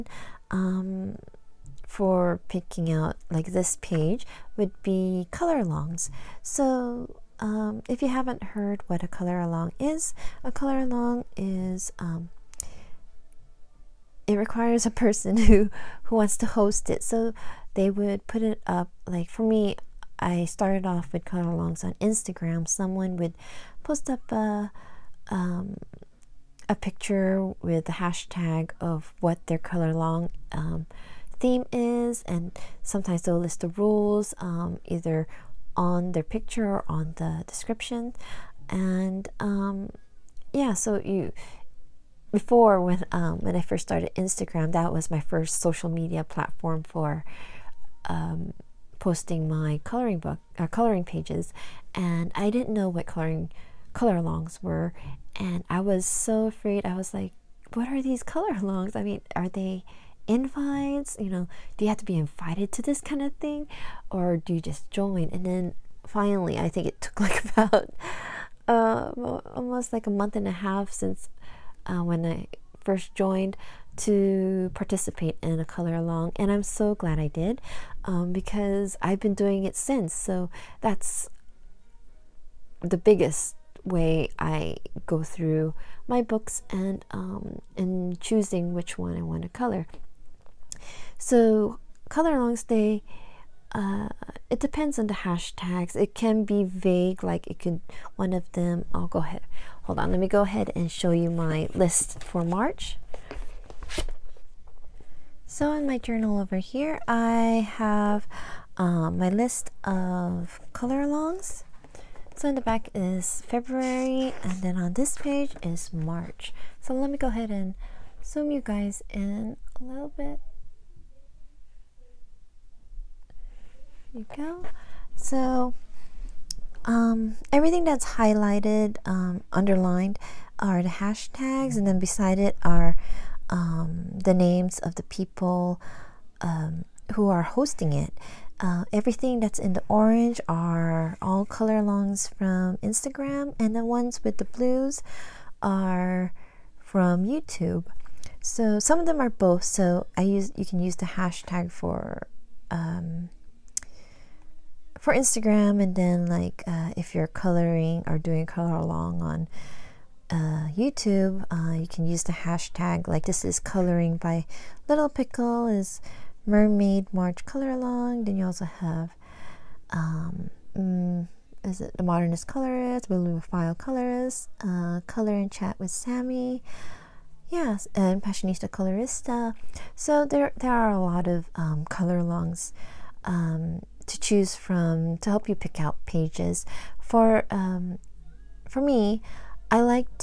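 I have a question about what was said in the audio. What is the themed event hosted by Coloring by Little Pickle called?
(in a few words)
Mermaid March.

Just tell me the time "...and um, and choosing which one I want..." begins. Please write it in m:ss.
1:26.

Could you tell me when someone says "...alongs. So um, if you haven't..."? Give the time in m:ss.
0:05.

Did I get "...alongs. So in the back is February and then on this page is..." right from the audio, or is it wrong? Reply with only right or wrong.
right.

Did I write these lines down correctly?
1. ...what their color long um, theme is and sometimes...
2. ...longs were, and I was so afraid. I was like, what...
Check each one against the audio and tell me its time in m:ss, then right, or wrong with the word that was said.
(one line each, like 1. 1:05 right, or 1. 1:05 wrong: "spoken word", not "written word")
1. 0:29 right
2. 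0:54 right.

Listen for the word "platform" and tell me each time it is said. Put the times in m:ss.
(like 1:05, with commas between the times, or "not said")
0:46.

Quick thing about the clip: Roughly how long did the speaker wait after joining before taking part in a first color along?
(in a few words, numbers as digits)
a month and a half.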